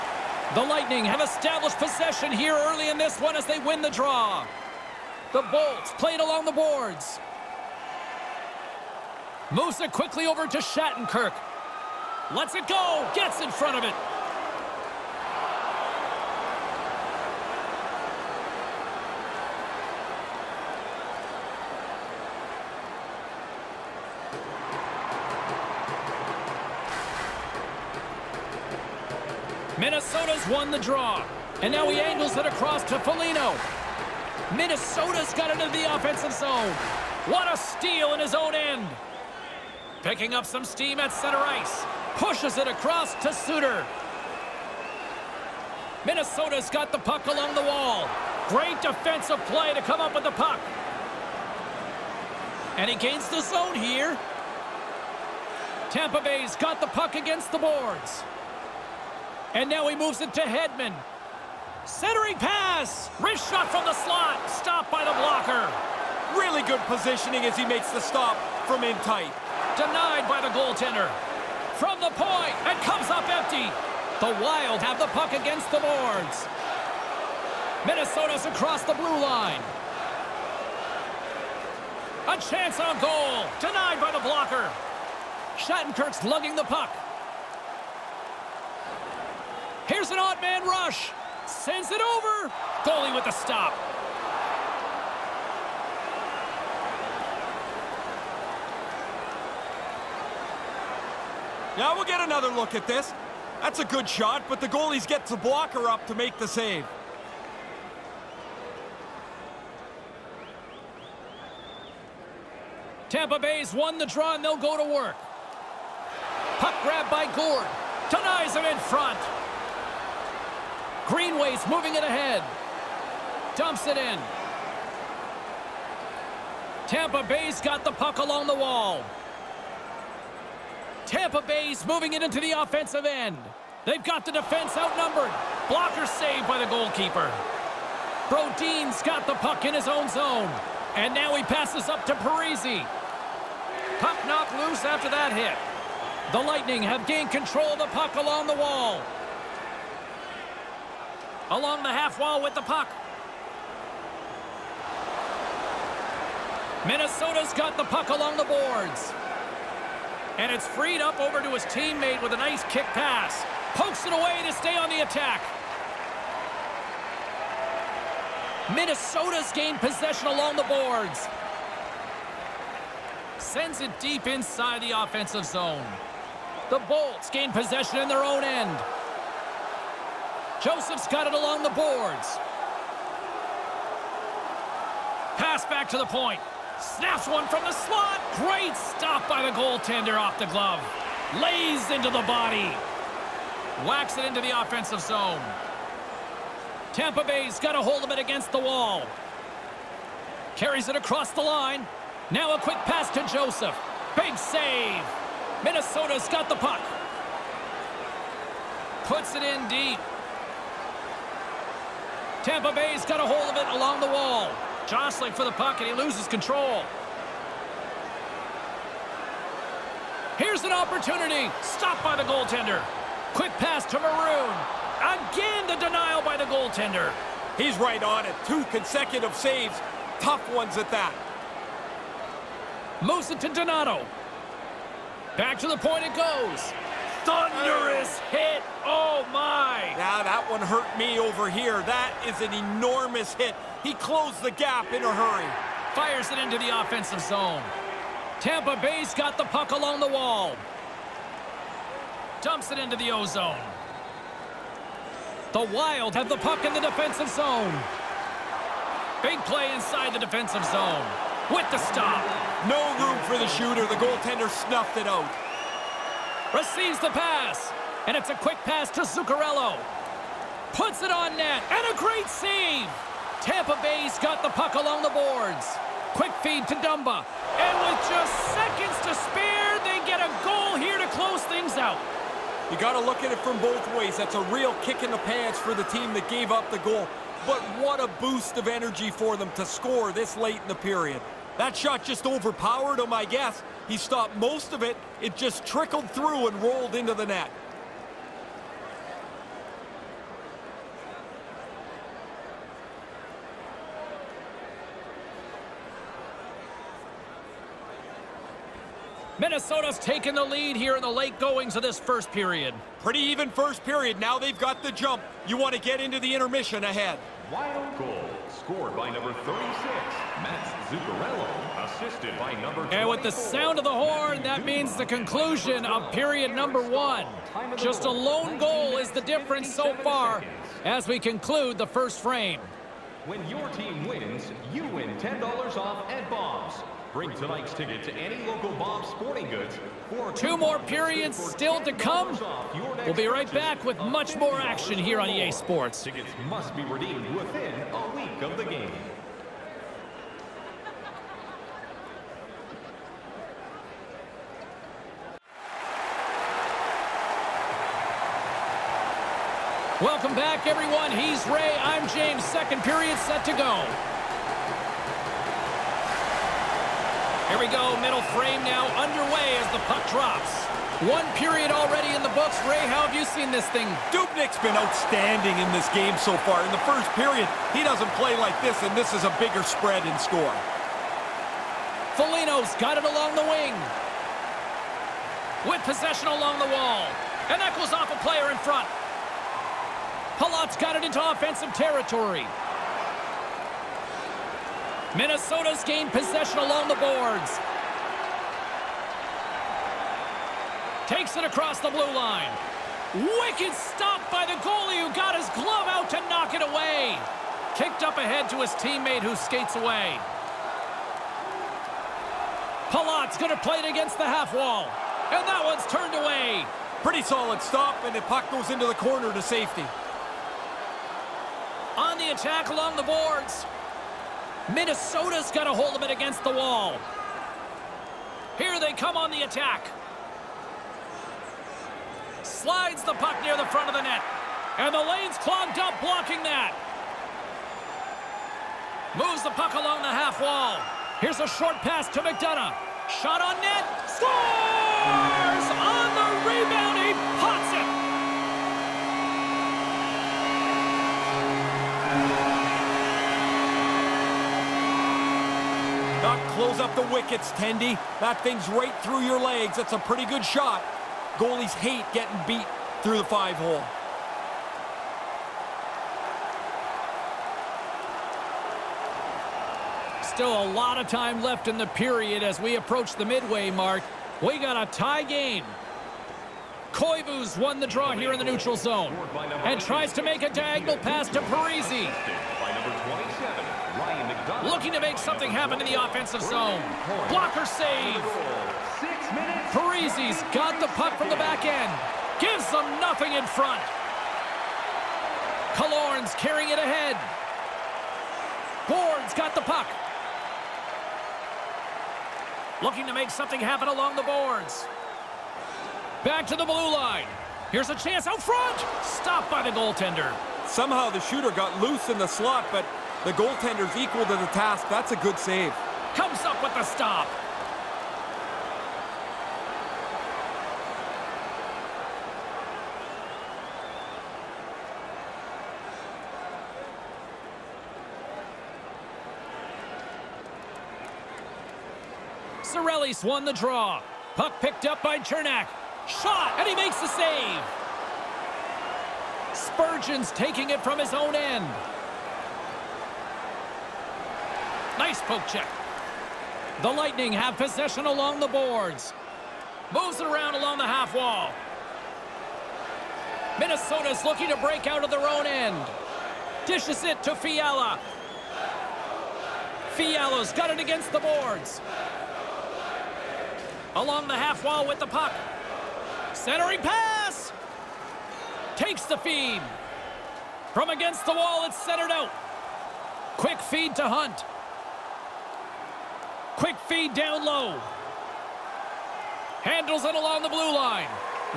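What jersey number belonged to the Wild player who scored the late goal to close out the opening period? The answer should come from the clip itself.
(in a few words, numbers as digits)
36.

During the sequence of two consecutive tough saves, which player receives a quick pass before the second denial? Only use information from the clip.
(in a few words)
Maroon.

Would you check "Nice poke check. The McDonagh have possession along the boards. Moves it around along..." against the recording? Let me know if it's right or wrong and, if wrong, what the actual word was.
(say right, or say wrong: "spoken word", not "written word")
wrong: "Lightning", not "McDonagh".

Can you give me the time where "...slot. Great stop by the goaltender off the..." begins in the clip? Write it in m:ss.
3:07.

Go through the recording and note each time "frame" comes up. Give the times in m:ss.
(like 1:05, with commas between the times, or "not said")
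5:32, 6:08.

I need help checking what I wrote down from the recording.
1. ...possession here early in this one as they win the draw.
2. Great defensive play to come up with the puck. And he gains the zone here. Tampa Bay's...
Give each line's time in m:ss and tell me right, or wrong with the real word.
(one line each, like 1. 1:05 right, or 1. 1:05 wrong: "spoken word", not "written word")
1. 0:01 right
2. 0:48 right.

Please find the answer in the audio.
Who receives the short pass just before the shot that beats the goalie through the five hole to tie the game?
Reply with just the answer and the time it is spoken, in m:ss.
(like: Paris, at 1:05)
McDonagh, at 7:22.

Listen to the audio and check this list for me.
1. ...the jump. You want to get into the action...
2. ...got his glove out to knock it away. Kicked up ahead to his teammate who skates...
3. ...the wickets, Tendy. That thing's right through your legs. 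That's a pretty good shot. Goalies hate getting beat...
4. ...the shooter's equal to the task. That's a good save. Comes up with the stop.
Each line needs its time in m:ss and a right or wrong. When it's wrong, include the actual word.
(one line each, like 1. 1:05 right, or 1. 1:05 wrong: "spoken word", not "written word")
1. 5:14 wrong: "intermission", not "action"
2. 6:45 right
3. 7:36 right
4. 8:33 wrong: "goaltender", not "shooter".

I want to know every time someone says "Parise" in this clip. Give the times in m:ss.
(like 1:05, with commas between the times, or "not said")
2:22, 8:01, 8:09.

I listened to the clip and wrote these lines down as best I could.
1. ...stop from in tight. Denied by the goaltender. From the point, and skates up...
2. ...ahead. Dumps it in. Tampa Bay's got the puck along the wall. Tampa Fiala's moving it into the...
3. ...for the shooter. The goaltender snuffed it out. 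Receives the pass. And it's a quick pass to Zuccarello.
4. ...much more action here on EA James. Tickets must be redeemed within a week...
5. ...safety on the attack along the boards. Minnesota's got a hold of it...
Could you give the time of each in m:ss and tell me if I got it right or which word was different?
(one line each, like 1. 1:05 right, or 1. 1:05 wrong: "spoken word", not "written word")
1. 1:07 wrong: "comes", not "skates"
2. 2:02 wrong: "Bay", not "Fiala"
3. 4:23 right
4. 5:43 wrong: "Sports", not "James"
5. 6:59 right.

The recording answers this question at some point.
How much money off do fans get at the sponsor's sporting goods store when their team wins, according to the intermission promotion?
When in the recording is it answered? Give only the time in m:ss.
5:35.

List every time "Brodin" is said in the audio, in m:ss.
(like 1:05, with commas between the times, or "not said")
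2:18.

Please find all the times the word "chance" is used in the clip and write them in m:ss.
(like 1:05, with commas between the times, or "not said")
1:22, 8:27.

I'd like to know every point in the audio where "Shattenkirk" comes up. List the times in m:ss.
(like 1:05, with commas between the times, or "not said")
0:10, 1:25.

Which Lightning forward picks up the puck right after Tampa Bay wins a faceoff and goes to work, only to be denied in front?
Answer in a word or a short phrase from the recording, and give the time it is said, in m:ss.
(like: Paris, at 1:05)
Gourde, at 1:57.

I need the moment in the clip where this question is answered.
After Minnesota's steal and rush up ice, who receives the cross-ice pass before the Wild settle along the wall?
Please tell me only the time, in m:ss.
0:43.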